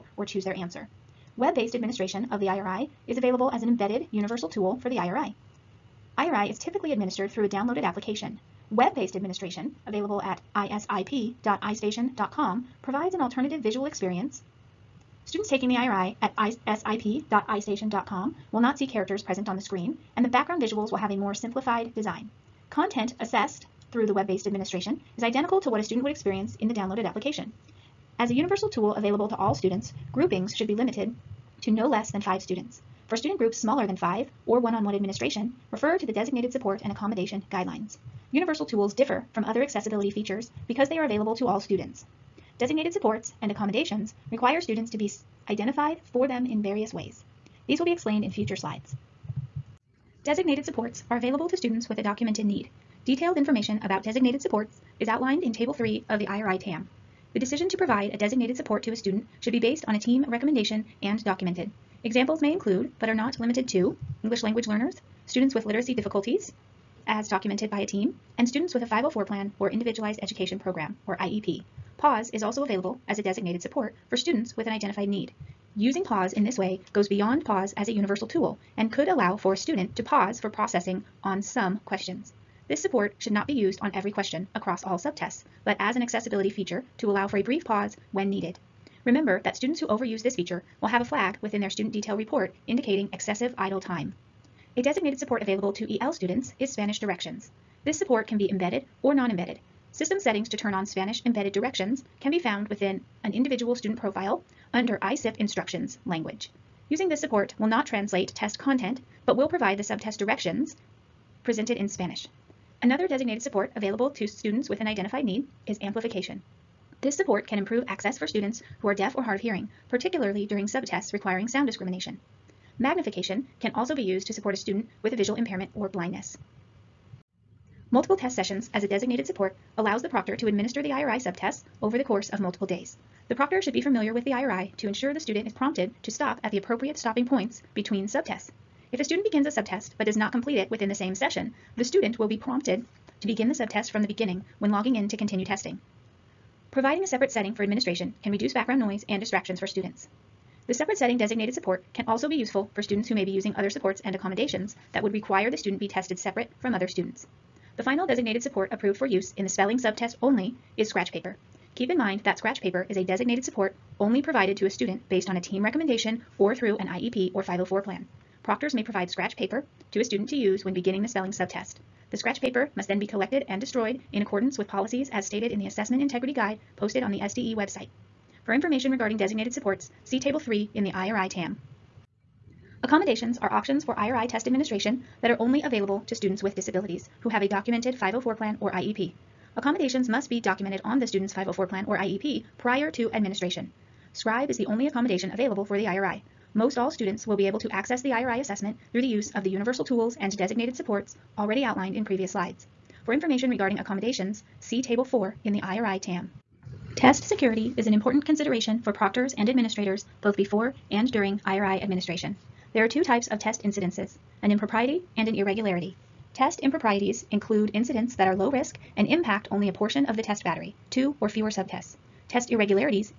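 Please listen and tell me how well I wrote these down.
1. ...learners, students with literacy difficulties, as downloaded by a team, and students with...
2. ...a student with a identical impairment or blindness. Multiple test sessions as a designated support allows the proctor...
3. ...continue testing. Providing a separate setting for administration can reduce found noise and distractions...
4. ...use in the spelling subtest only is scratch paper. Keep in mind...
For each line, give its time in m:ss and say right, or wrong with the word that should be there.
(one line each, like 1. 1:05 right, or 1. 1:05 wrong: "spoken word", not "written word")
1. 1:04 wrong: "documented", not "downloaded"
2. 2:04 wrong: "visual", not "identical"
3. 2:25 wrong: "background", not "found"
4. 2:39 right.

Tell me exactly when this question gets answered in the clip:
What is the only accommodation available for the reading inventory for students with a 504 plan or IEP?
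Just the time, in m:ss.
3:14.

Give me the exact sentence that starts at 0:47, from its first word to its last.
These will be explained in future slides.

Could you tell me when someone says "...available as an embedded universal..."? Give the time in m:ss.
0:03.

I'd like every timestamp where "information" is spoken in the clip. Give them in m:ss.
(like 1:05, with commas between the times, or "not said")
0:53, 2:58, 3:23.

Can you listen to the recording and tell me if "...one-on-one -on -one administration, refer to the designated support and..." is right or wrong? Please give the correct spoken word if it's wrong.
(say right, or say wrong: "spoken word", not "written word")
right.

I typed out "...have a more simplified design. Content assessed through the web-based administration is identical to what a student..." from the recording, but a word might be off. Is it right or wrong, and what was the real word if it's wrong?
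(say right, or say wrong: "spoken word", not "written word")
right.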